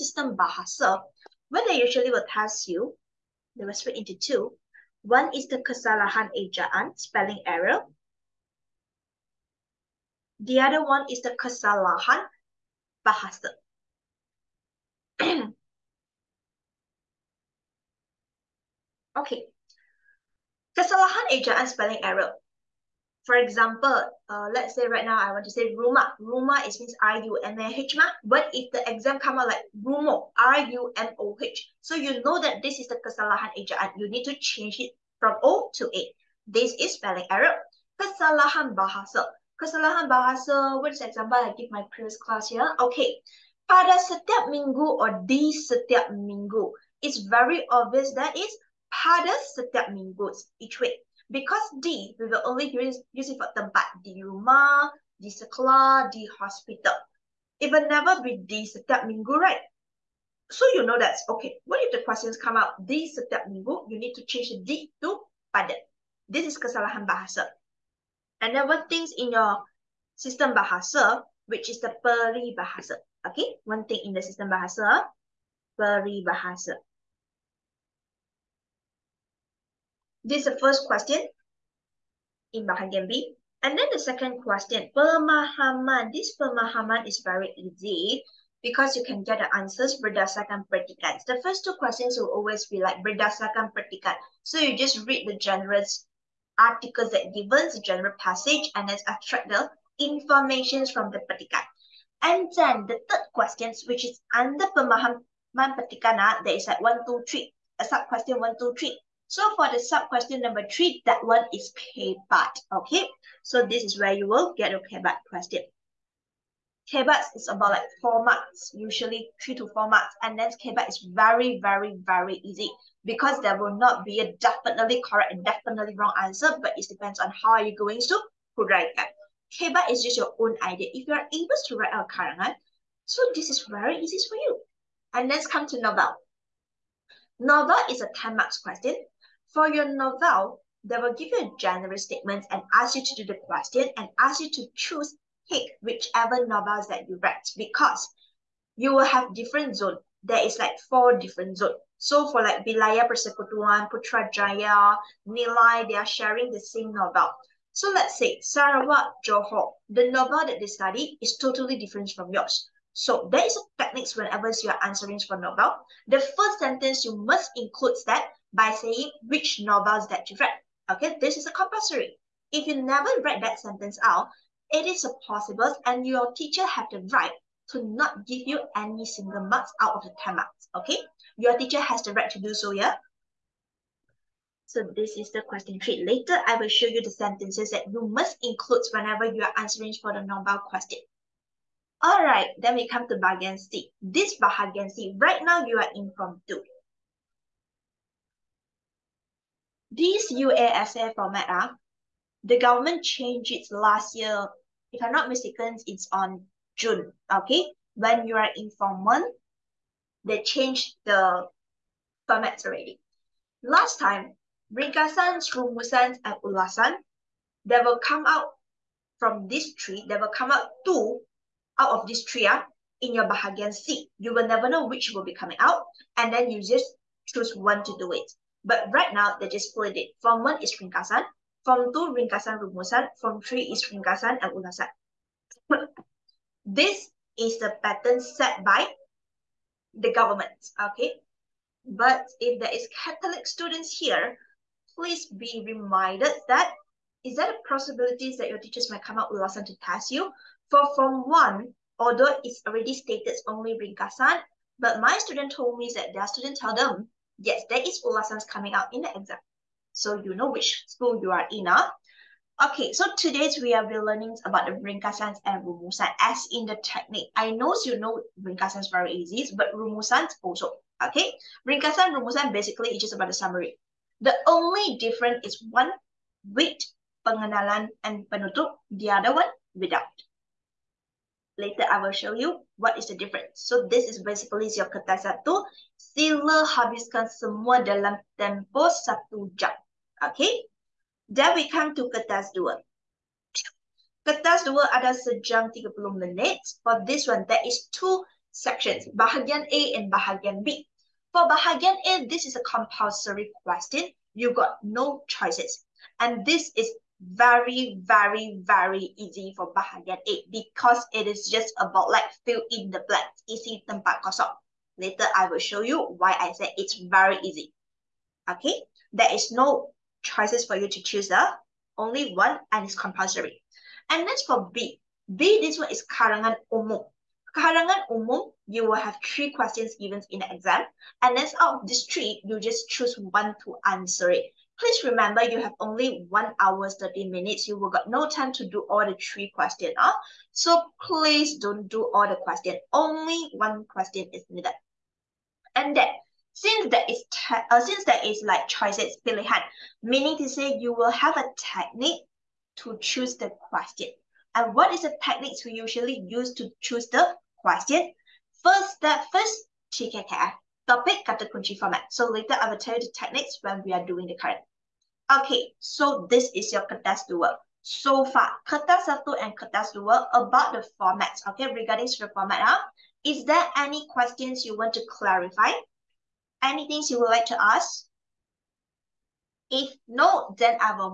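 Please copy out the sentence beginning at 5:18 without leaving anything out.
Okay, there is no choices for you to choose, uh, only one and it's compulsory.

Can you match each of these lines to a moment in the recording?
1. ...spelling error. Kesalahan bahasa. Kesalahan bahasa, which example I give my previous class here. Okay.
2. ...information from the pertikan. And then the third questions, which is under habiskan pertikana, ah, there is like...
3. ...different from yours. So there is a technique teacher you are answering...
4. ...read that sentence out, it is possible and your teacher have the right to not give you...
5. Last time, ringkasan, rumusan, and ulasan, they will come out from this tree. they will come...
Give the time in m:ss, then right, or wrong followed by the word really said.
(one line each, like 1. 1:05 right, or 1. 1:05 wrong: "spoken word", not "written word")
1. 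0:36 right
2. 1:40 wrong: "pemahaman", not "habiskan"
3. 2:41 wrong: "whenever", not "teacher"
4. 2:53 right
5. 3:33 right.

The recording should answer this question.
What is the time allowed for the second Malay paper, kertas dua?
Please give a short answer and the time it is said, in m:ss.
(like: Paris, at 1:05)
1 hour 30 minutes, at 4:55.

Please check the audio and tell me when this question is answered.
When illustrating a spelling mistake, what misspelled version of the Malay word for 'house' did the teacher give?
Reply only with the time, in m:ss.
0:30.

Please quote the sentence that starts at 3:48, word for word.
But right now, they just split it.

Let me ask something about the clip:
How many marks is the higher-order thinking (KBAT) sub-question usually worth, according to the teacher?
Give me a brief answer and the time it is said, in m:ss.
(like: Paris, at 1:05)
3 to 4 marks, at 1:59.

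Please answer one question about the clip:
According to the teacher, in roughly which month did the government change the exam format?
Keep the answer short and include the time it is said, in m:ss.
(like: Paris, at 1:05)
June, at 3:26.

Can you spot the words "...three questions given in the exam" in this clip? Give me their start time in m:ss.
5:29.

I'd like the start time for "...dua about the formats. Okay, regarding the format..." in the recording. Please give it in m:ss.
6:09.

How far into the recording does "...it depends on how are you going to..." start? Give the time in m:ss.
2:06.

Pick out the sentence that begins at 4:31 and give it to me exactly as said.
Okay, ringkasan Rumusan basically it's just about the summary.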